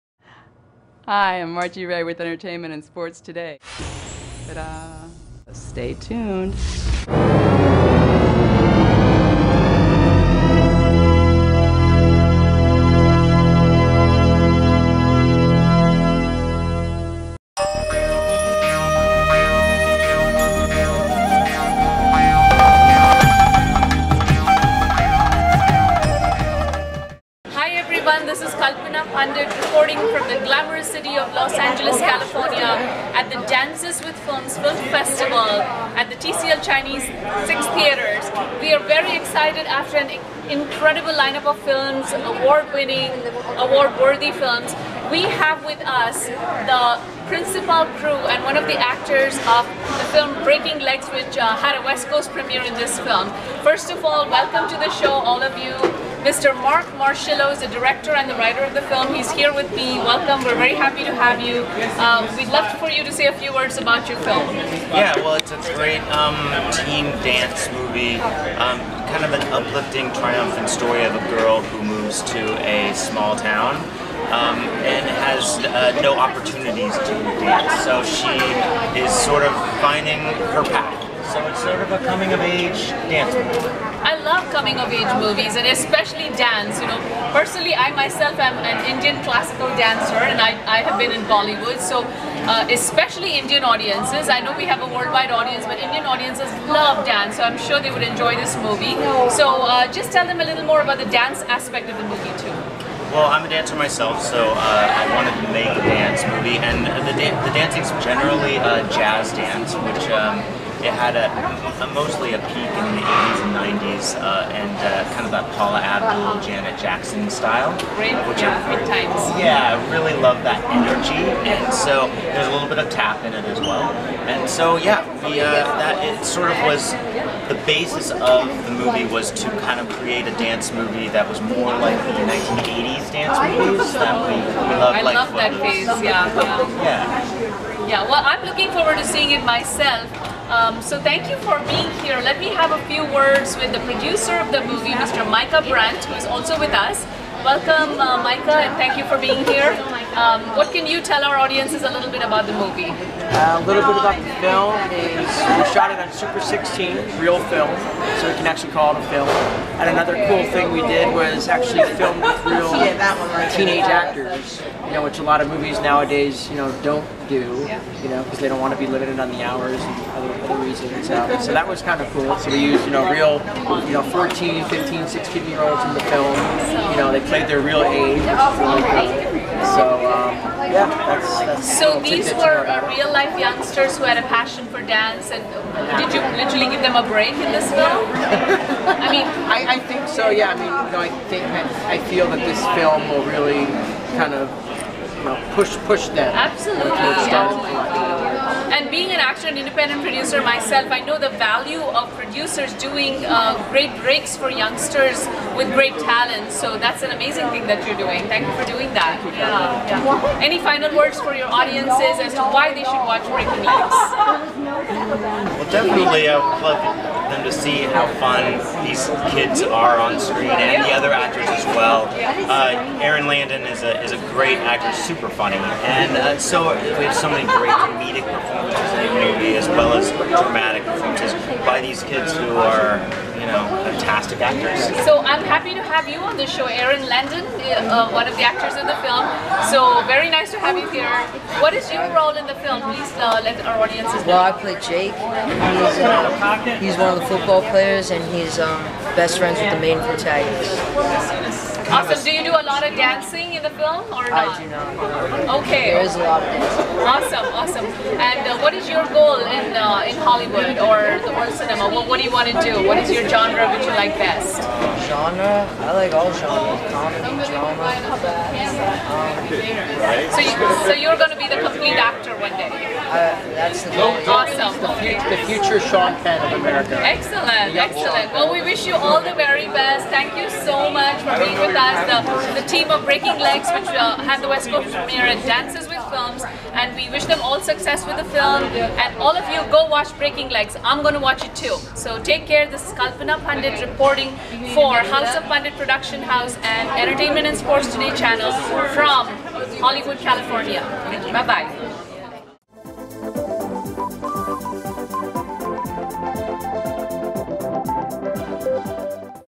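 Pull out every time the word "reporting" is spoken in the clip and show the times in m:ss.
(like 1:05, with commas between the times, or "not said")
0:29, 4:53.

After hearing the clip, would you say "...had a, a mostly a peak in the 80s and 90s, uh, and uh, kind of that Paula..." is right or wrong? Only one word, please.
right.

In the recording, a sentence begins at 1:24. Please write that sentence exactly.
I love coming of age movies and especially dance.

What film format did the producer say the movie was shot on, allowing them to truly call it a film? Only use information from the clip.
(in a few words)
Super 16.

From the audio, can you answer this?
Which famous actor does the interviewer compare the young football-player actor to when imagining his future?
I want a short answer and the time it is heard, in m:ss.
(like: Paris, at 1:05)
Sean Penn, at 4:35.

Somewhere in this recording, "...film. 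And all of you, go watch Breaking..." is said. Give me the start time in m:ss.
4:48.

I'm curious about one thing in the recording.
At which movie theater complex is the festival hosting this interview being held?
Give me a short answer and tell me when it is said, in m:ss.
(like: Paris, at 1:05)
TCL Chinese Six Theaters, at 0:36.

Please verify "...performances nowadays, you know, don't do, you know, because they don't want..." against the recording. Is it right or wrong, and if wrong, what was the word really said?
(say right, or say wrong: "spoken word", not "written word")
wrong: "movies", not "performances".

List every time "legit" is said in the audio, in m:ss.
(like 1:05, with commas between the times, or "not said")
not said.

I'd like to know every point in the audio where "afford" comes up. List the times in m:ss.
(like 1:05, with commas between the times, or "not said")
not said.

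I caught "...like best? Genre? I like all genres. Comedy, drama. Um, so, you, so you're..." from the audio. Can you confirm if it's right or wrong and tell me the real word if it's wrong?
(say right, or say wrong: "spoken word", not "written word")
right.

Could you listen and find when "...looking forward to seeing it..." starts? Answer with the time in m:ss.
2:18.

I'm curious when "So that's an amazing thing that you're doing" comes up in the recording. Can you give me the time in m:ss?
3:26.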